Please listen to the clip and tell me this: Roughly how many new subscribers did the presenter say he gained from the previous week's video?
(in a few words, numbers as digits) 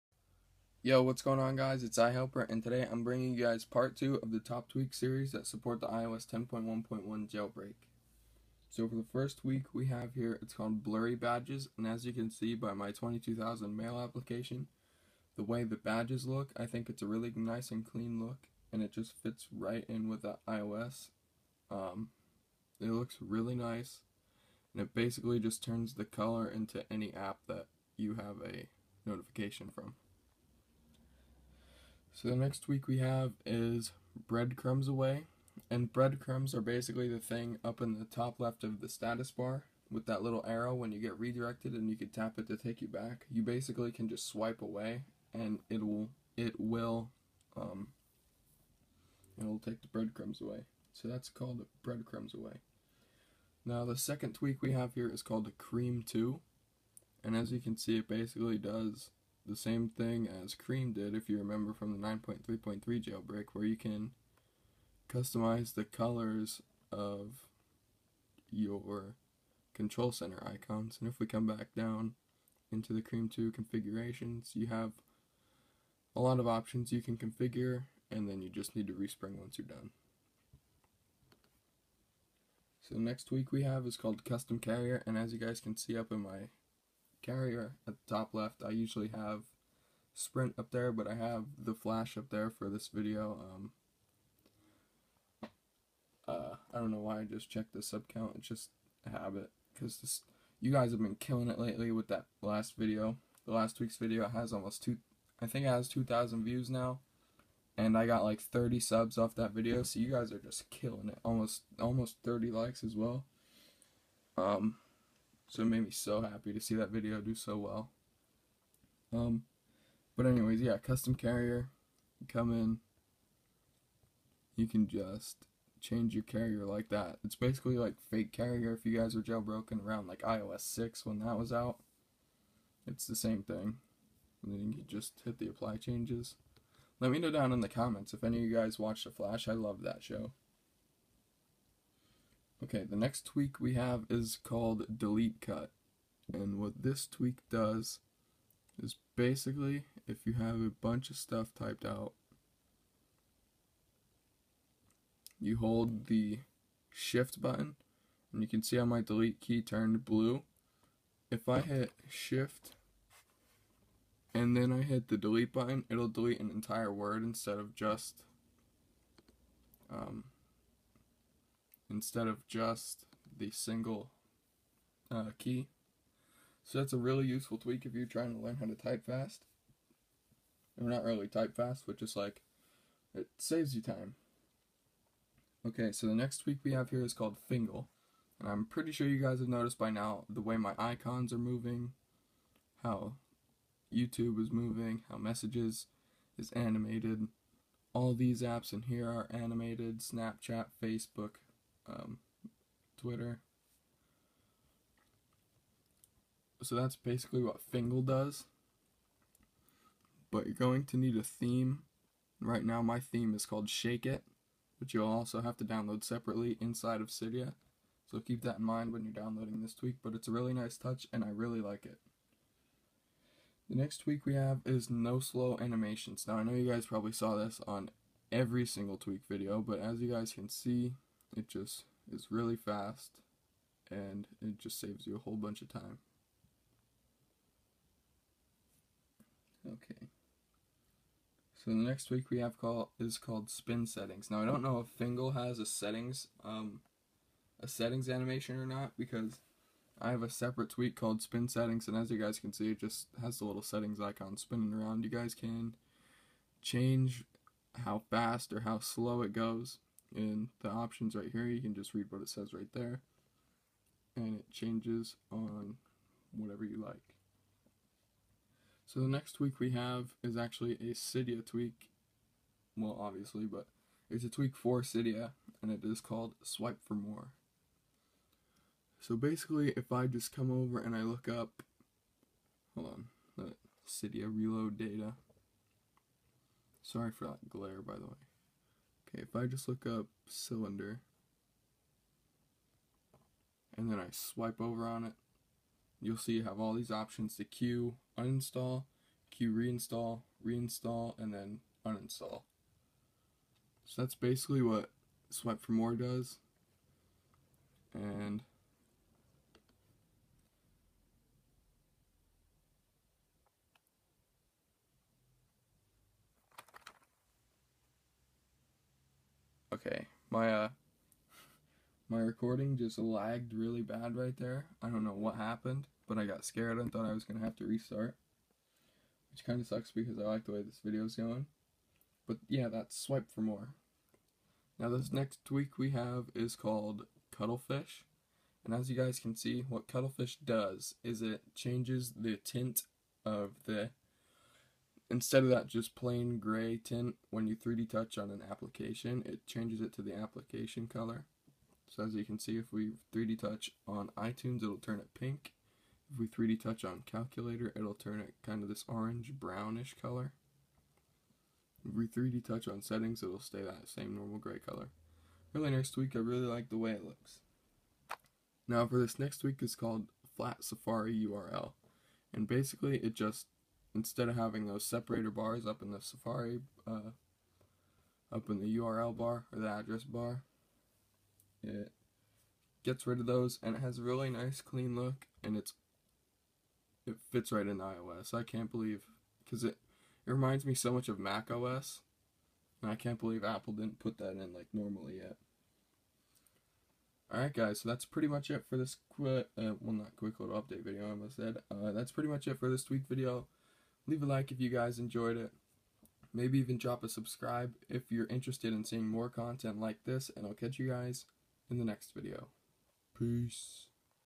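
30.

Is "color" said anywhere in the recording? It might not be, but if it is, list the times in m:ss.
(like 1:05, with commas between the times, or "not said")
0:26, 1:05, 5:50, 6:00, 6:04.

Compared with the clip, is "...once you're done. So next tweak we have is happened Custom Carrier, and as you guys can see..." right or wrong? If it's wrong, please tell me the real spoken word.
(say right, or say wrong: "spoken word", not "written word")
wrong: "called", not "happened".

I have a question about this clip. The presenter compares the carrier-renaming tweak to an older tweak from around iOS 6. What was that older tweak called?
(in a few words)
Fake Carrier.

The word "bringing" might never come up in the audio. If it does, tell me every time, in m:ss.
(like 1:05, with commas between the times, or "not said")
0:03.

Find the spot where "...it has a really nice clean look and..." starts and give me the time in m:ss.
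6:23.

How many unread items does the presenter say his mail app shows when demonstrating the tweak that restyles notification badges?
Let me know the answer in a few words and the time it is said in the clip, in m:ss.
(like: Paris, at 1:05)
22,000, at 0:12.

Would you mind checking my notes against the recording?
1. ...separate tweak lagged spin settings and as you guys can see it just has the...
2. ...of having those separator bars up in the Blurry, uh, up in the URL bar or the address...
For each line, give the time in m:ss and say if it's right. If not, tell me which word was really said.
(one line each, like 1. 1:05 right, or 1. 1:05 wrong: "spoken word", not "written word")
1. 4:10 wrong: "called", not "lagged"
2. 6:14 wrong: "Safari", not "Blurry".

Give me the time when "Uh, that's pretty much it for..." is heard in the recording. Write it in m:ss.
6:41.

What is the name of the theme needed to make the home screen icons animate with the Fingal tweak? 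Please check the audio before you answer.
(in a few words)
Shake It.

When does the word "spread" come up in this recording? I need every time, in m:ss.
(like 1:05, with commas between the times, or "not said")
not said.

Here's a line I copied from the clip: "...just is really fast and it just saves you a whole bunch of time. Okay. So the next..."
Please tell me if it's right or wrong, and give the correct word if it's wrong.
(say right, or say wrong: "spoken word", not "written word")
right.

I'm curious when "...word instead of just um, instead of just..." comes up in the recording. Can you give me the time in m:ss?
2:46.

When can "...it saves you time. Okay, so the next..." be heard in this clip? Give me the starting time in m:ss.
3:03.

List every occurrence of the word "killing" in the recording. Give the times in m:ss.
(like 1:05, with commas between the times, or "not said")
1:41, 1:50.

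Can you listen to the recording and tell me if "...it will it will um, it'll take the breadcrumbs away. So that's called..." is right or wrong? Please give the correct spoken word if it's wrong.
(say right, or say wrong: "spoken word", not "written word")
right.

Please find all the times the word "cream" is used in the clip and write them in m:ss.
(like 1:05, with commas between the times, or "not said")
0:55, 1:00, 1:13.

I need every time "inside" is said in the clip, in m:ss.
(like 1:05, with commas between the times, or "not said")
3:36.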